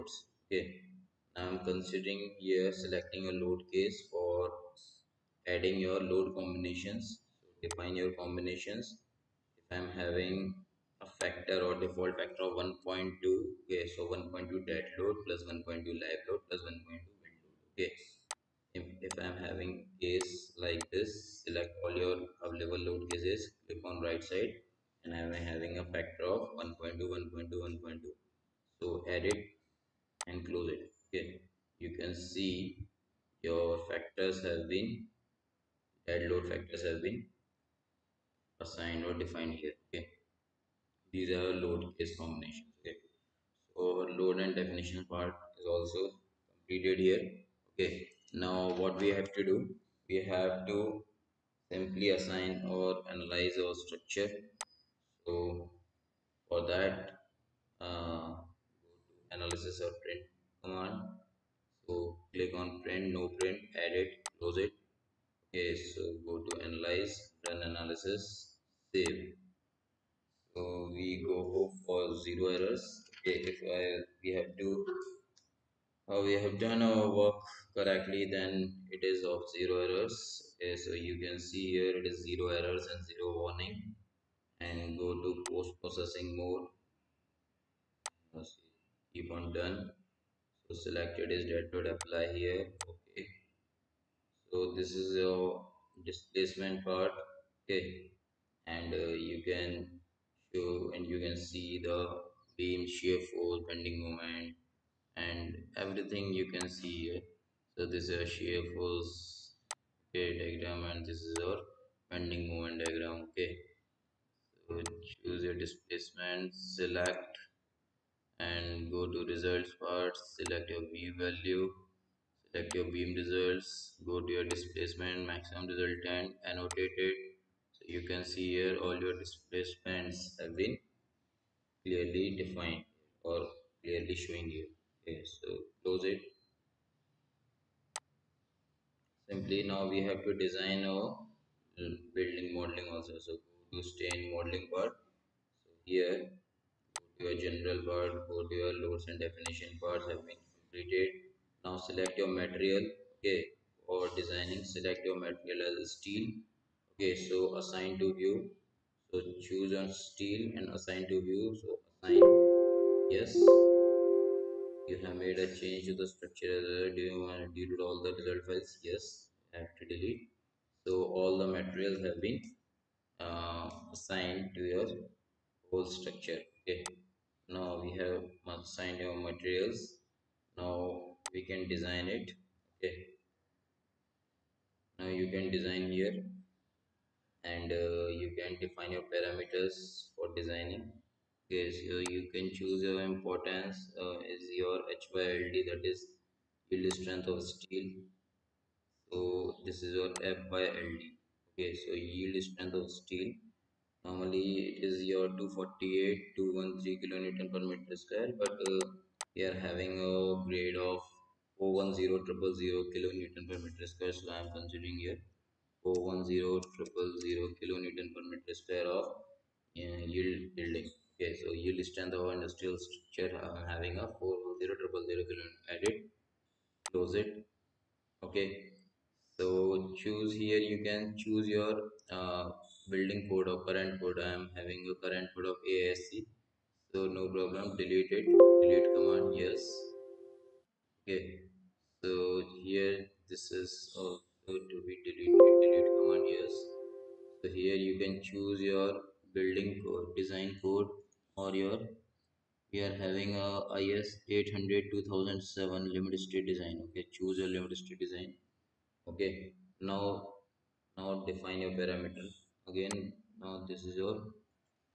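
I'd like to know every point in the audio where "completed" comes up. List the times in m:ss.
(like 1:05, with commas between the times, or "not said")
0:46, 2:30.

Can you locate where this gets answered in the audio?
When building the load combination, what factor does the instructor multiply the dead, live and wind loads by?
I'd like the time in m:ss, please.
0:11.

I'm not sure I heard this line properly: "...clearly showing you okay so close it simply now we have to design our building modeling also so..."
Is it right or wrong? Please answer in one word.
right.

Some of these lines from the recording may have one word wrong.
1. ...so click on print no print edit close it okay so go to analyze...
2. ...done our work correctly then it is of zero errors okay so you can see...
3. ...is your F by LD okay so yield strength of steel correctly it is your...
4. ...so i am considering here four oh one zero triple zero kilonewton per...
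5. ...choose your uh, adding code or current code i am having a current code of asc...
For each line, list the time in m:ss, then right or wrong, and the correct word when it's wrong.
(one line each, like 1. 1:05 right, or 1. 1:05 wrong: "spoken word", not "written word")
1. 1:01 right
2. 1:16 right
3. 3:19 wrong: "normally", not "correctly"
4. 3:34 right
5. 3:51 wrong: "building", not "adding".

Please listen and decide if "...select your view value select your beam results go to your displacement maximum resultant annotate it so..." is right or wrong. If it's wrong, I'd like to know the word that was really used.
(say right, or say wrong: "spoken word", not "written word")
right.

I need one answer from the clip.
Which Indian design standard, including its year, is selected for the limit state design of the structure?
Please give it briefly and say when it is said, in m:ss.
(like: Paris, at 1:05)
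IS 800 2007, at 4:13.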